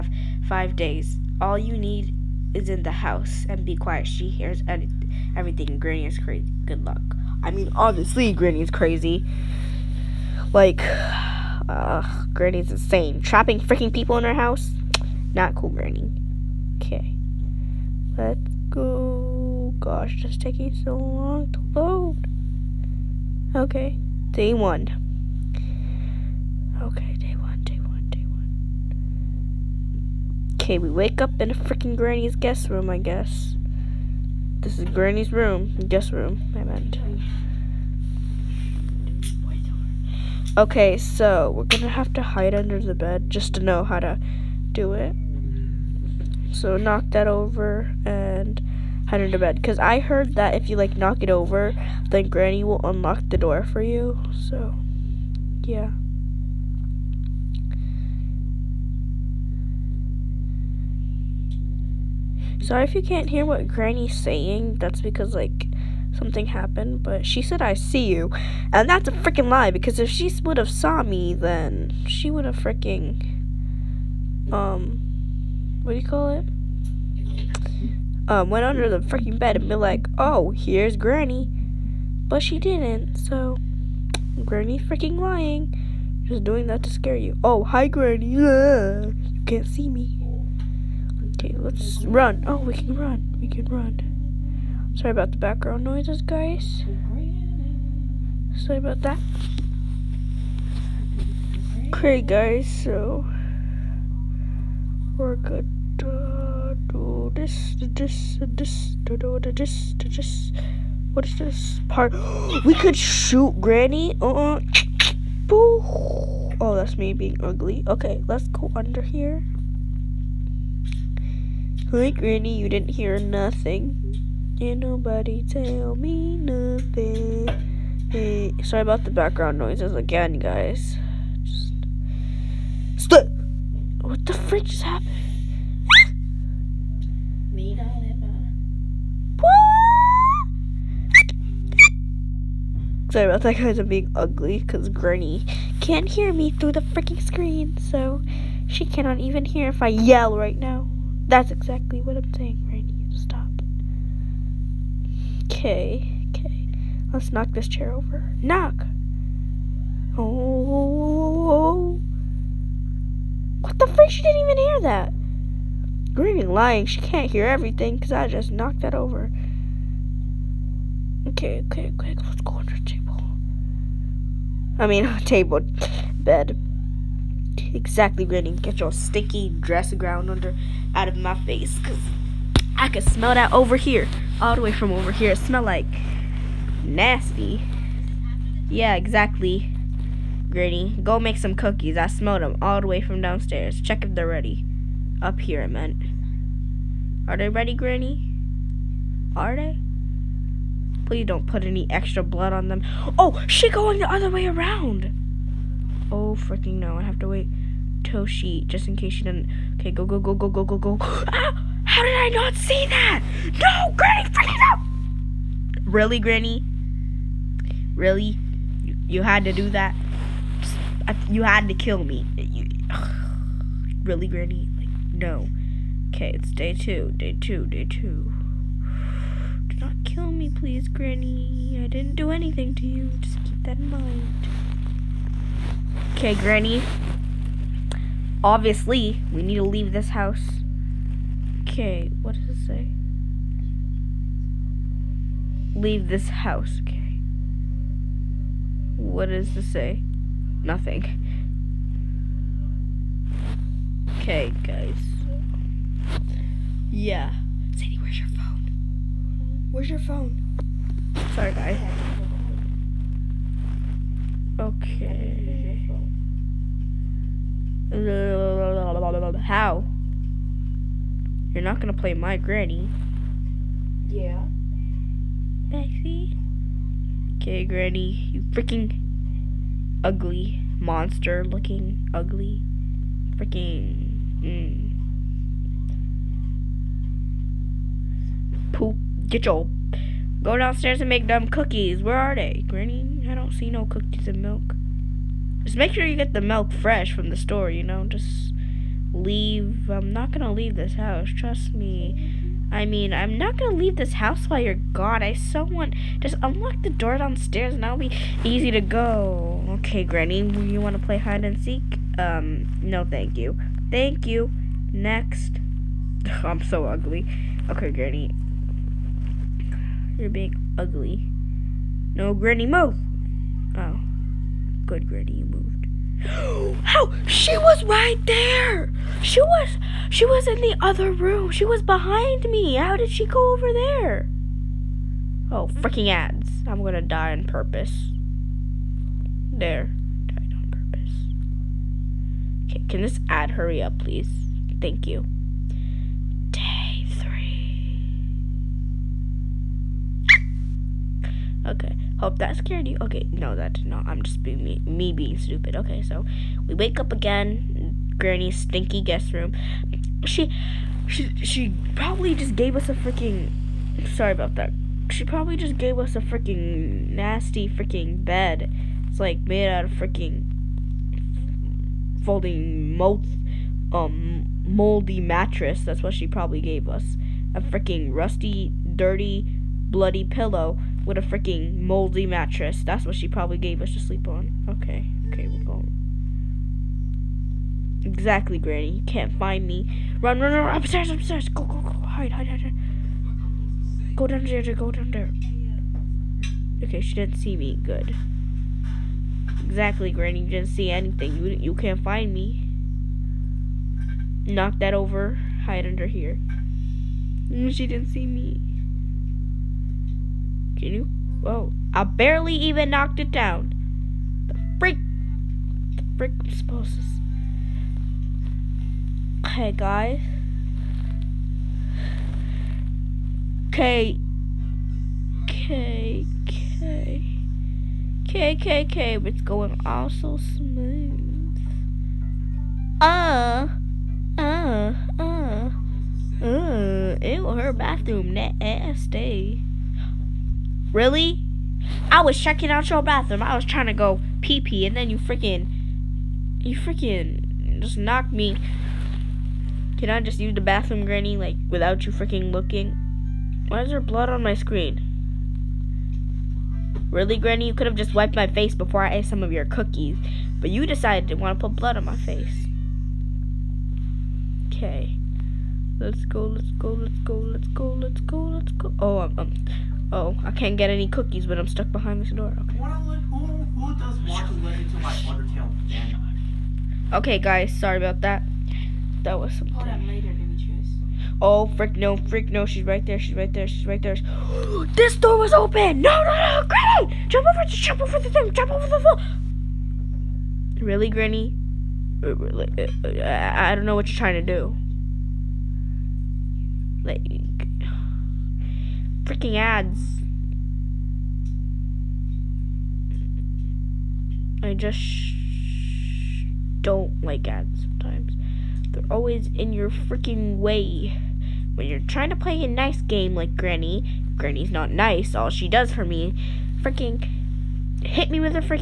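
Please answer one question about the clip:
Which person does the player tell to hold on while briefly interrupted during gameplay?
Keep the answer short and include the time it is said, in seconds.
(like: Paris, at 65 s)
Demetrius, at 480 s.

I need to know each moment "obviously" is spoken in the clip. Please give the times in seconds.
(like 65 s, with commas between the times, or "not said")
7 s, 238 s.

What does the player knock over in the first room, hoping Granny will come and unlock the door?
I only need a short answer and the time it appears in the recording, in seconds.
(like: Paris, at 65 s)
chair, at 157 s.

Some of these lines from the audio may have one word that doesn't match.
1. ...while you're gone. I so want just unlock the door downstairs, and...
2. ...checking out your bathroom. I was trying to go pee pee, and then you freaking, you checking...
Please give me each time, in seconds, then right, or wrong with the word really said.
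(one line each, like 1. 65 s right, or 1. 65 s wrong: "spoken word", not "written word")
1. 304 s right
2. 442 s wrong: "freaking", not "checking".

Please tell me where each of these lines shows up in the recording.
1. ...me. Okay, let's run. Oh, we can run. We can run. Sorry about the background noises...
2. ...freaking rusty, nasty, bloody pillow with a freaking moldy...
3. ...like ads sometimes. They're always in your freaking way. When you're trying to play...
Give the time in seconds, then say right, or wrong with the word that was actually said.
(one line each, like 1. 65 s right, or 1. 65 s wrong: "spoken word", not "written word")
1. 89 s right
2. 377 s wrong: "dirty", not "nasty"
3. 507 s right.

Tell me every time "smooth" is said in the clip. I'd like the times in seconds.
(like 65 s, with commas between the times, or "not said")
430 s.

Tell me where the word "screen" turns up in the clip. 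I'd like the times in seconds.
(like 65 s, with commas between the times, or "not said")
147 s, 454 s.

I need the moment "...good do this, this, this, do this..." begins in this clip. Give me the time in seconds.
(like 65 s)
105 s.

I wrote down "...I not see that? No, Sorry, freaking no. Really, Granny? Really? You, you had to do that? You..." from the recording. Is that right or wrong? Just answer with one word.
wrong.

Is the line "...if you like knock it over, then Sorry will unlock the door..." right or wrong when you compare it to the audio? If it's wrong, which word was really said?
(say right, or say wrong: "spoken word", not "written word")
wrong: "Granny", not "Sorry".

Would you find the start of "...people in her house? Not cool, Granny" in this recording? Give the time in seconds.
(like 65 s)
13 s.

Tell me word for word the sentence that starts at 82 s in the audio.
But she didn't, so Granny's freaking lying.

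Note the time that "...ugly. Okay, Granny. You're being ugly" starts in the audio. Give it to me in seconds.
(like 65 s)
316 s.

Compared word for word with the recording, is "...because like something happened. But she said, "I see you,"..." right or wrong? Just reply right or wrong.
right.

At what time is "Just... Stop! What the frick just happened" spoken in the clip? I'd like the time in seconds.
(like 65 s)
131 s.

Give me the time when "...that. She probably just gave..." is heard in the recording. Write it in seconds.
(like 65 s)
364 s.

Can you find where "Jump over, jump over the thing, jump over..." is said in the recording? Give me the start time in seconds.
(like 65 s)
487 s.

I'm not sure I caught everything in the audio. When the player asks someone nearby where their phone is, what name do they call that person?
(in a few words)
Sadie.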